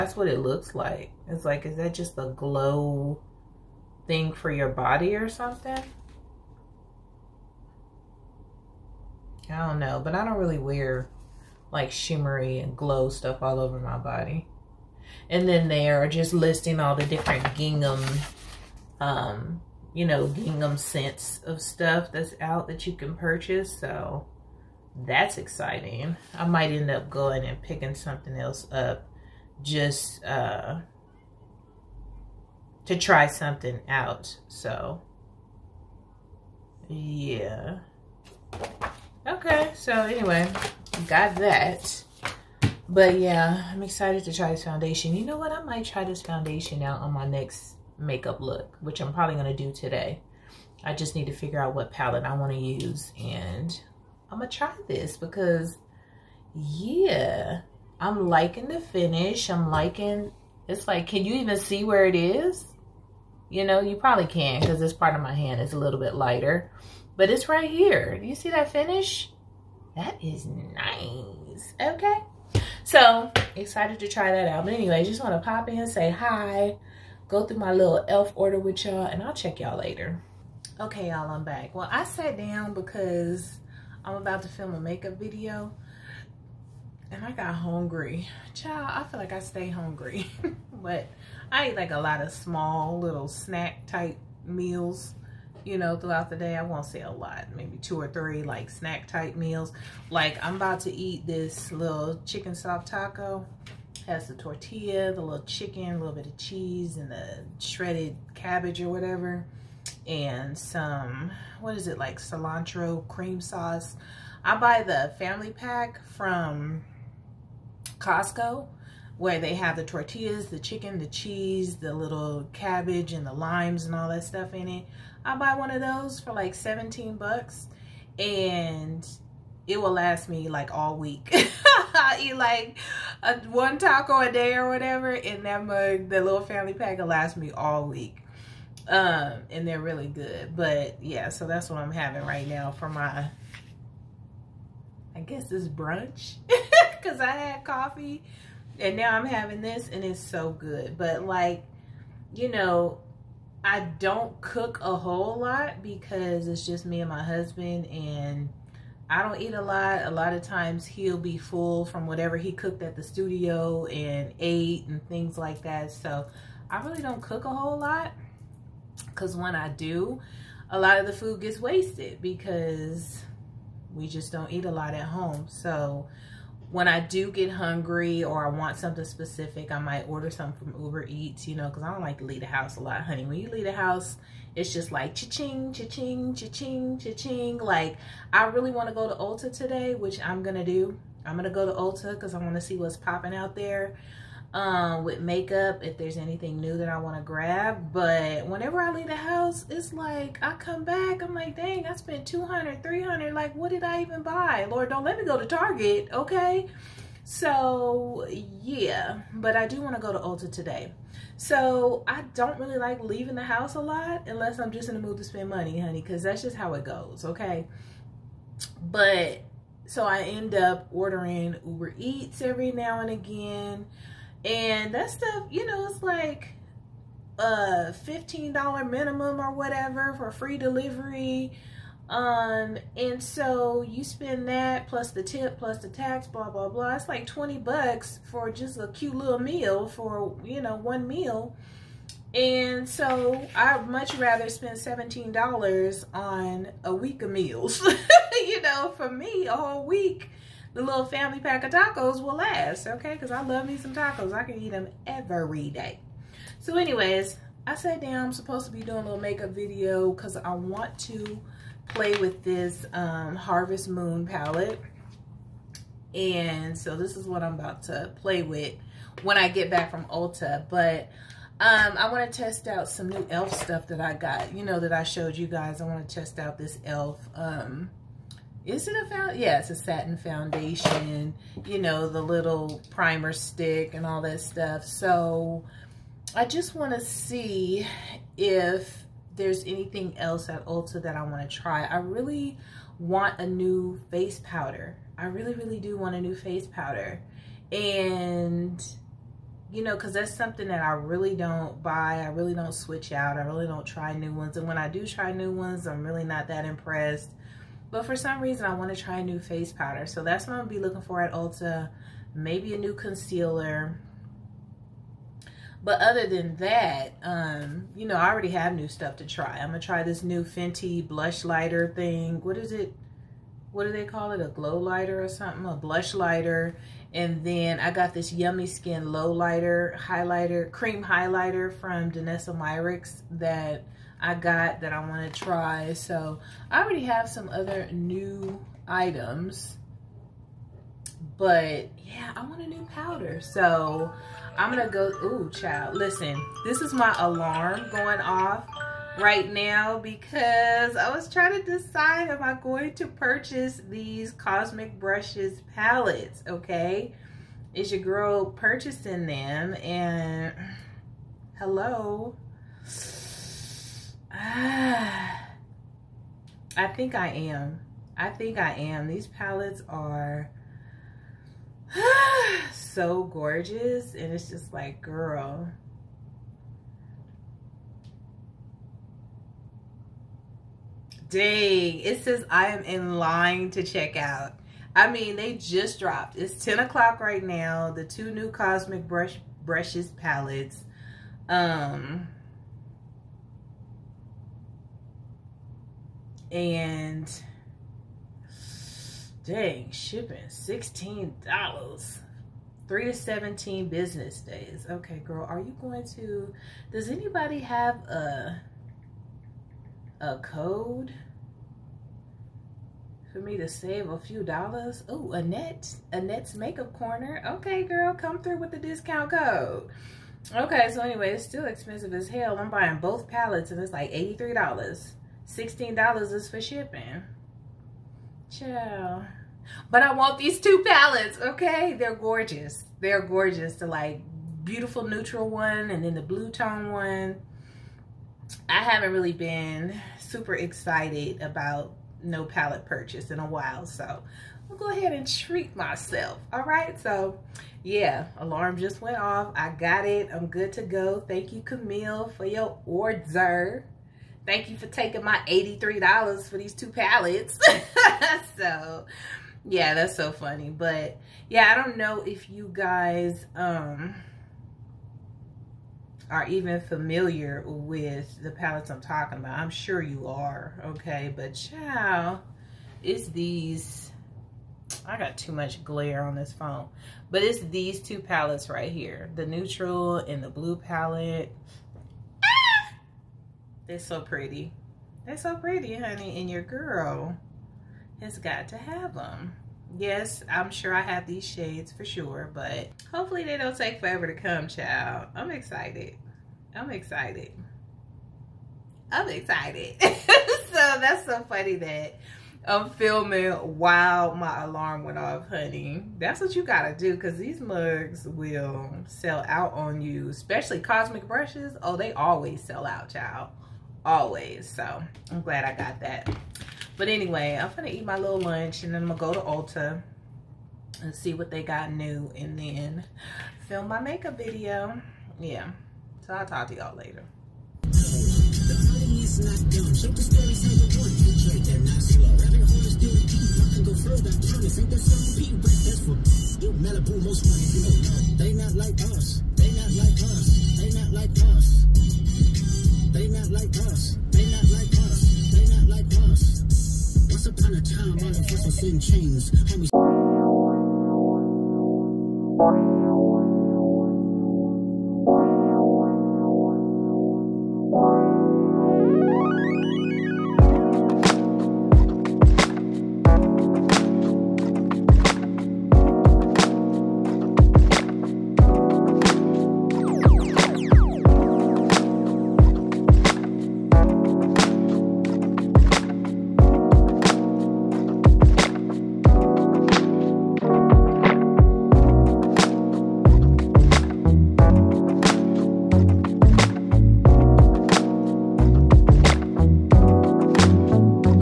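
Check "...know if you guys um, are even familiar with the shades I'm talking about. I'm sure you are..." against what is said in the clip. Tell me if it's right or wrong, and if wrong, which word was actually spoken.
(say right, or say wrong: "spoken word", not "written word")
wrong: "palettes", not "shades".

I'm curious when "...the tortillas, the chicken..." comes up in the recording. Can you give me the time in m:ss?
1:59.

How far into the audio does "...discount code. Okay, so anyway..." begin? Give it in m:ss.
6:58.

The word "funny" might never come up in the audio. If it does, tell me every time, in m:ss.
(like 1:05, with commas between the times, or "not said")
7:40, 8:21.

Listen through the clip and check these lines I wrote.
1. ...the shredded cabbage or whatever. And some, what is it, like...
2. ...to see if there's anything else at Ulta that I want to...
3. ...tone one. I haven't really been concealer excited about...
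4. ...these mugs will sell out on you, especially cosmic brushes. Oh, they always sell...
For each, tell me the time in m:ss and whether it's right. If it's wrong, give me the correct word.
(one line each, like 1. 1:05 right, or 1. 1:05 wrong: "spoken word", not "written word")
1. 1:47 right
2. 4:46 right
3. 7:16 wrong: "super", not "concealer"
4. 8:27 right.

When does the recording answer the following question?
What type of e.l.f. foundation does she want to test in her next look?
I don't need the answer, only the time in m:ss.
4:39.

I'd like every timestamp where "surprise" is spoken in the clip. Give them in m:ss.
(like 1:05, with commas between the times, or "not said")
not said.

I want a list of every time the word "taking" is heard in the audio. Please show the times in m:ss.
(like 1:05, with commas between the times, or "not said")
7:34.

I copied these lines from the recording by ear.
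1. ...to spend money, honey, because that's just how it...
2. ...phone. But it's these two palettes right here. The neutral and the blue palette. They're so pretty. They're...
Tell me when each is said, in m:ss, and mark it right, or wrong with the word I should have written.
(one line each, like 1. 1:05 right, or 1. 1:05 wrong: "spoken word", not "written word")
1. 3:35 right
2. 7:56 right.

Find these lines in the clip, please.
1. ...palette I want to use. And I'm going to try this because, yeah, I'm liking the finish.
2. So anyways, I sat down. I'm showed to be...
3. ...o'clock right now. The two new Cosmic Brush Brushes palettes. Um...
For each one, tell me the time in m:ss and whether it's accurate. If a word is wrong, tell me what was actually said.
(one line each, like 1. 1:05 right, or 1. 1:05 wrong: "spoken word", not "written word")
1. 0:51 right
2. 4:16 wrong: "supposed", not "showed"
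3. 6:26 right.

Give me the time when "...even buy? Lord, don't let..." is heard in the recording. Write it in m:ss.
3:24.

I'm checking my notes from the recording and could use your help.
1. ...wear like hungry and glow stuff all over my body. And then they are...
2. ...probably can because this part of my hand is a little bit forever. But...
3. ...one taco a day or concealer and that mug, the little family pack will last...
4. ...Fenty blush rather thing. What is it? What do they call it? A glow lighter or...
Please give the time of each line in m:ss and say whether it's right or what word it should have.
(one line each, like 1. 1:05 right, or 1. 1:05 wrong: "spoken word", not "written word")
1. 0:10 wrong: "shimmery", not "hungry"
2. 1:03 wrong: "lighter", not "forever"
3. 2:13 wrong: "whatever", not "concealer"
4. 5:20 wrong: "lighter", not "rather".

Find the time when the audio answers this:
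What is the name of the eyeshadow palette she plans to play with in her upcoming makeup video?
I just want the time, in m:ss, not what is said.
4:23.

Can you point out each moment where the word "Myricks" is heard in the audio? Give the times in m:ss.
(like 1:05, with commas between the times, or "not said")
5:32.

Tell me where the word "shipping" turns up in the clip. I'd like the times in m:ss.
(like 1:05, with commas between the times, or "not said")
6:39, 7:06.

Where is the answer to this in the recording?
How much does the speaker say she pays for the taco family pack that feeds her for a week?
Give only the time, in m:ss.
2:06.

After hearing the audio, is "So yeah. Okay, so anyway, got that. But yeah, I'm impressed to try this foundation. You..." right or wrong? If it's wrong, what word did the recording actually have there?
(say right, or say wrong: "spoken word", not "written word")
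wrong: "excited", not "impressed".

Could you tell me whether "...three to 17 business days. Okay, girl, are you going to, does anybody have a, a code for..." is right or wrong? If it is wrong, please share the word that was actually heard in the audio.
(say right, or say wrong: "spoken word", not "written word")
right.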